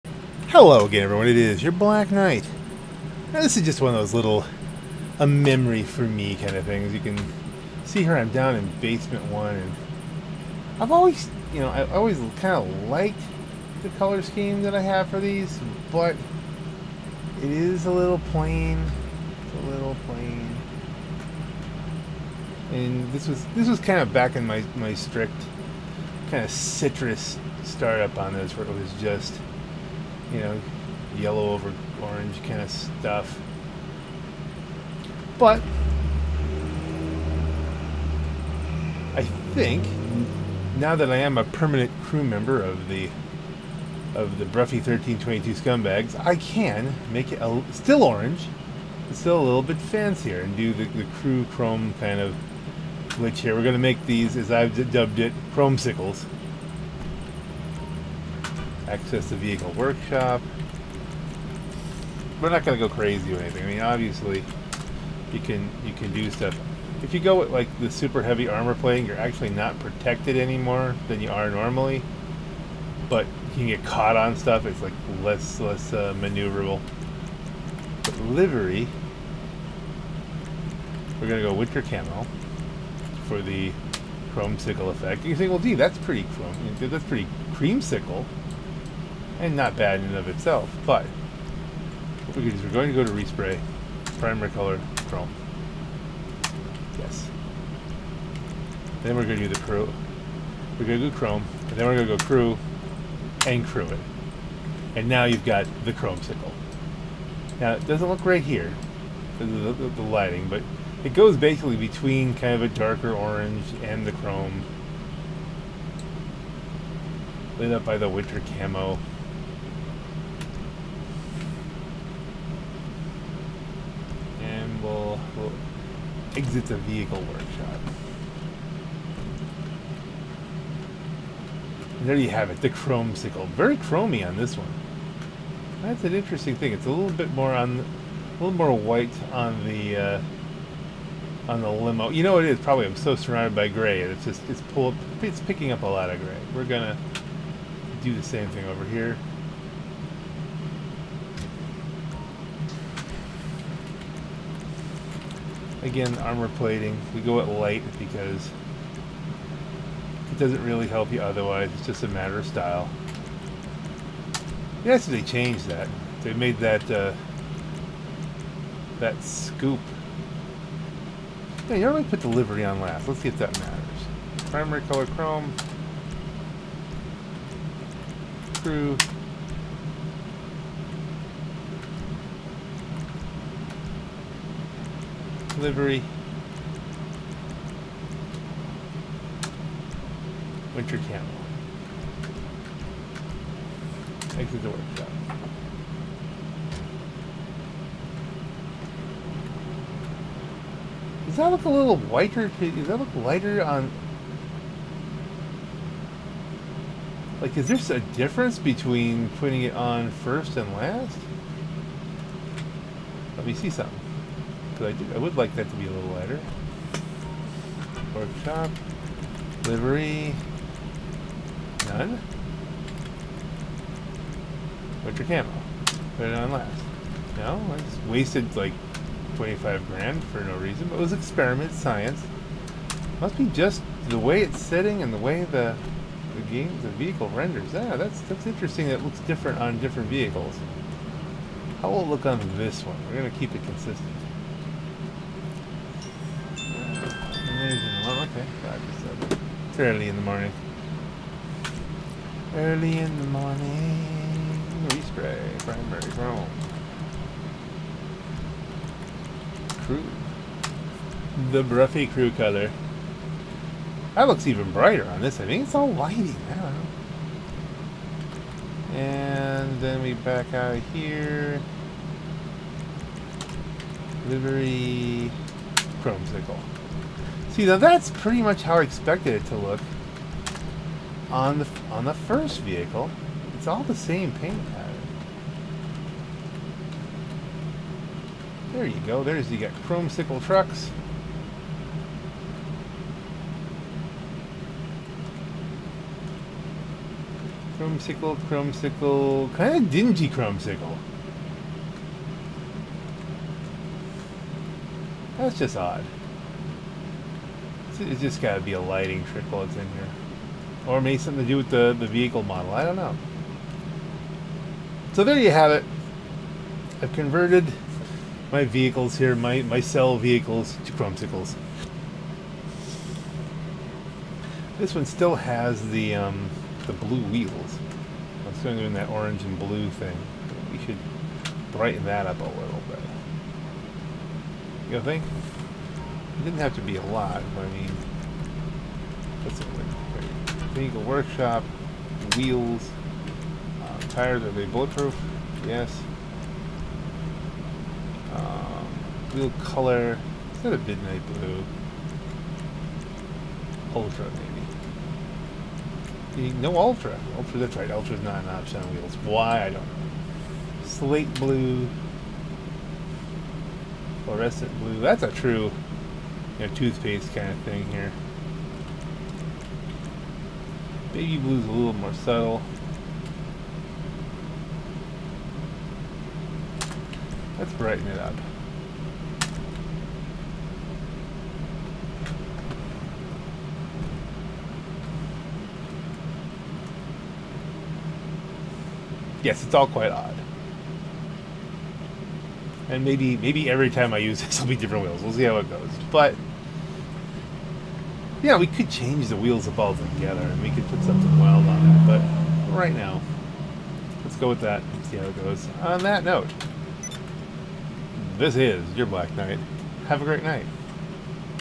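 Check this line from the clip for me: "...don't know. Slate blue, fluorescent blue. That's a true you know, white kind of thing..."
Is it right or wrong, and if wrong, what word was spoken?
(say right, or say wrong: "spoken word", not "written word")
wrong: "toothpaste", not "white".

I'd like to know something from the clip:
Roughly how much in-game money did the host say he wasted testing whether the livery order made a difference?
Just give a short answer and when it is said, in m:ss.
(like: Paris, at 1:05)
25 grand, at 3:49.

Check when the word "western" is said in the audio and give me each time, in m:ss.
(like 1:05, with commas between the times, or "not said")
not said.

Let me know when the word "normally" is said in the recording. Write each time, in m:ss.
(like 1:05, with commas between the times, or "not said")
1:11, 2:51.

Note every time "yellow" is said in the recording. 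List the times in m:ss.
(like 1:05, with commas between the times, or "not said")
0:31.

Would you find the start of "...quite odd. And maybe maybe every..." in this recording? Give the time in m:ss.
6:29.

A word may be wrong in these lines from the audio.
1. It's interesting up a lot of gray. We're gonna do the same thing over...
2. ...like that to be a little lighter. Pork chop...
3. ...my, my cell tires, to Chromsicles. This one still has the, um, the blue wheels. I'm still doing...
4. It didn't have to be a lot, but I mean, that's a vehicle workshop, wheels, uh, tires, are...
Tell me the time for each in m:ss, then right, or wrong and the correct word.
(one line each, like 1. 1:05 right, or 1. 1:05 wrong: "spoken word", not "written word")
1. 2:25 wrong: "picking", not "interesting"
2. 3:35 right
3. 5:19 wrong: "vehicles", not "tires"
4. 5:36 right.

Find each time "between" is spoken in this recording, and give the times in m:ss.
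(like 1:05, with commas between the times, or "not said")
1:51, 3:28.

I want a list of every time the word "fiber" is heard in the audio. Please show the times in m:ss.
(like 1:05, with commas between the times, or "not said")
not said.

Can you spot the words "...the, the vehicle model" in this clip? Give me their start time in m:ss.
5:11.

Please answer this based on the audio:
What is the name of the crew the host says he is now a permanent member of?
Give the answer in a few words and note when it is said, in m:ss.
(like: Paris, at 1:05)
Broughy 1322 Scumbags, at 0:44.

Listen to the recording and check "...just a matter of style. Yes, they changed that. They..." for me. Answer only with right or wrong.
right.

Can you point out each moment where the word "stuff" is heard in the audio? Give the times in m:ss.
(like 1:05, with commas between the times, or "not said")
0:32, 1:06, 1:14.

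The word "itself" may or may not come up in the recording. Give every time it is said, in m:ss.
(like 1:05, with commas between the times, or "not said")
1:30.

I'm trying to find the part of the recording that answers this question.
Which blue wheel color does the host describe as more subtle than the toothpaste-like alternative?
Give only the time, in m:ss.
6:11.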